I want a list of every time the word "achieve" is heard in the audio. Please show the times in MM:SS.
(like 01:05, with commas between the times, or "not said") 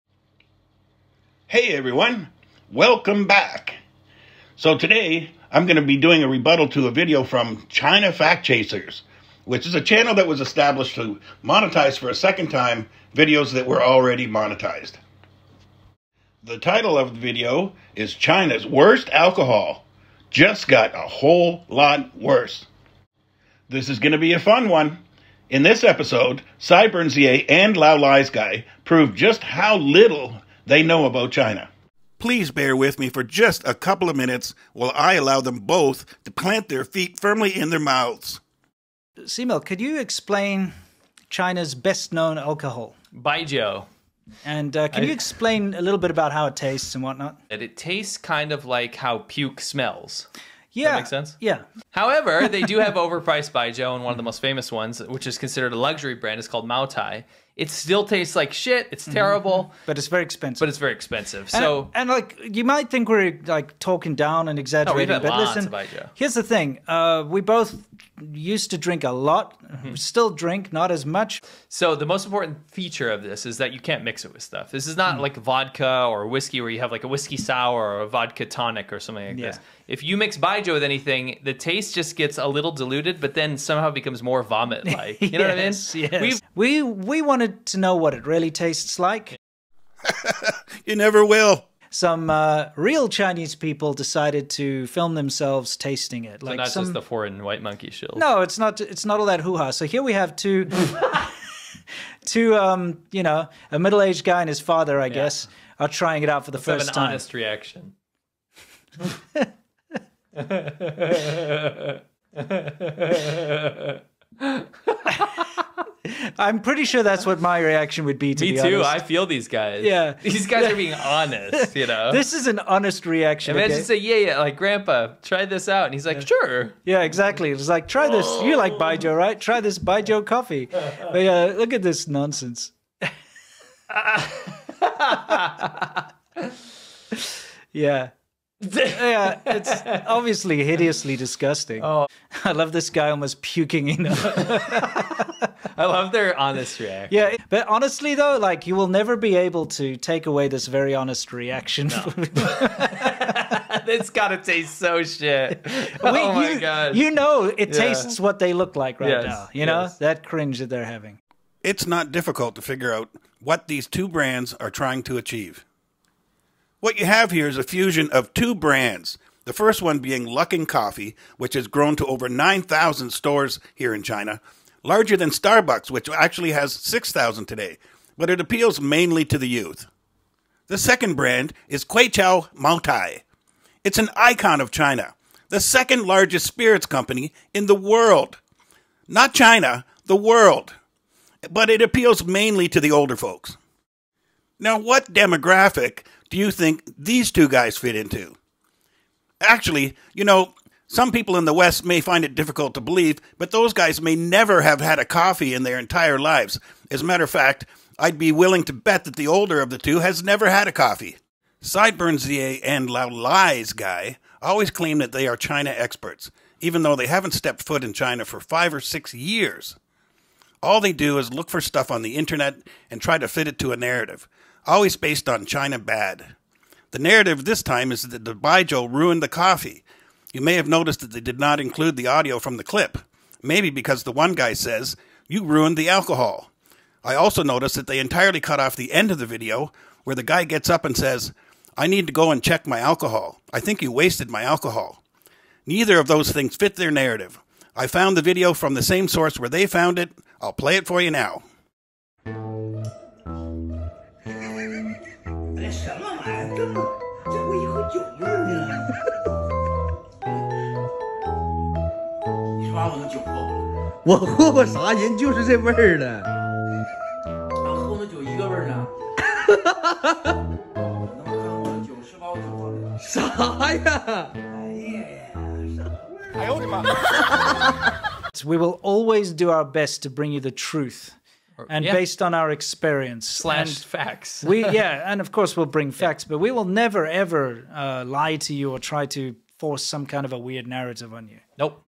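02:45.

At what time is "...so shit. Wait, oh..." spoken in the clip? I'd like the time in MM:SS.
02:34.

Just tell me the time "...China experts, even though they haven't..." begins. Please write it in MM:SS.
03:35.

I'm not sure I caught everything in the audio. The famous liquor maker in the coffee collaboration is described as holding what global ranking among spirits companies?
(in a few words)
second largest.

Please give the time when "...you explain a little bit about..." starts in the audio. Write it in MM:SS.
00:45.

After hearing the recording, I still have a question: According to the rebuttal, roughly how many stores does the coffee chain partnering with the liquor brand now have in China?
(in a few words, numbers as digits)
9,000.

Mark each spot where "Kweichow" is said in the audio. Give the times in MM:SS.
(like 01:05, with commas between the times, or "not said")
03:01.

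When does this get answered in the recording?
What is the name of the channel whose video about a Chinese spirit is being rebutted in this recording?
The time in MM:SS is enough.
00:07.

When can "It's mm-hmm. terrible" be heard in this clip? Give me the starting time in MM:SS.
00:58.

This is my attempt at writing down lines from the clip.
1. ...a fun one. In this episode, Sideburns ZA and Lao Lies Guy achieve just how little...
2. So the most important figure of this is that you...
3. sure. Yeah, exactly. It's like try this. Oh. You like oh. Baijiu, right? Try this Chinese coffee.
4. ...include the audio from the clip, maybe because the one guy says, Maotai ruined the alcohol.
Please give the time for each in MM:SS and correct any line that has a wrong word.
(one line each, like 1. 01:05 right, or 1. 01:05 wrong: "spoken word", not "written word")
1. 00:24 wrong: "prove", not "achieve"
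2. 01:11 wrong: "feature", not "figure"
3. 02:06 wrong: "Baijiu", not "Chinese"
4. 03:51 wrong: "You", not "Maotai".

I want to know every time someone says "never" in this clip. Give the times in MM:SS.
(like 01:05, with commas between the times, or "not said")
01:30, 02:28, 03:24, 03:30, 04:46.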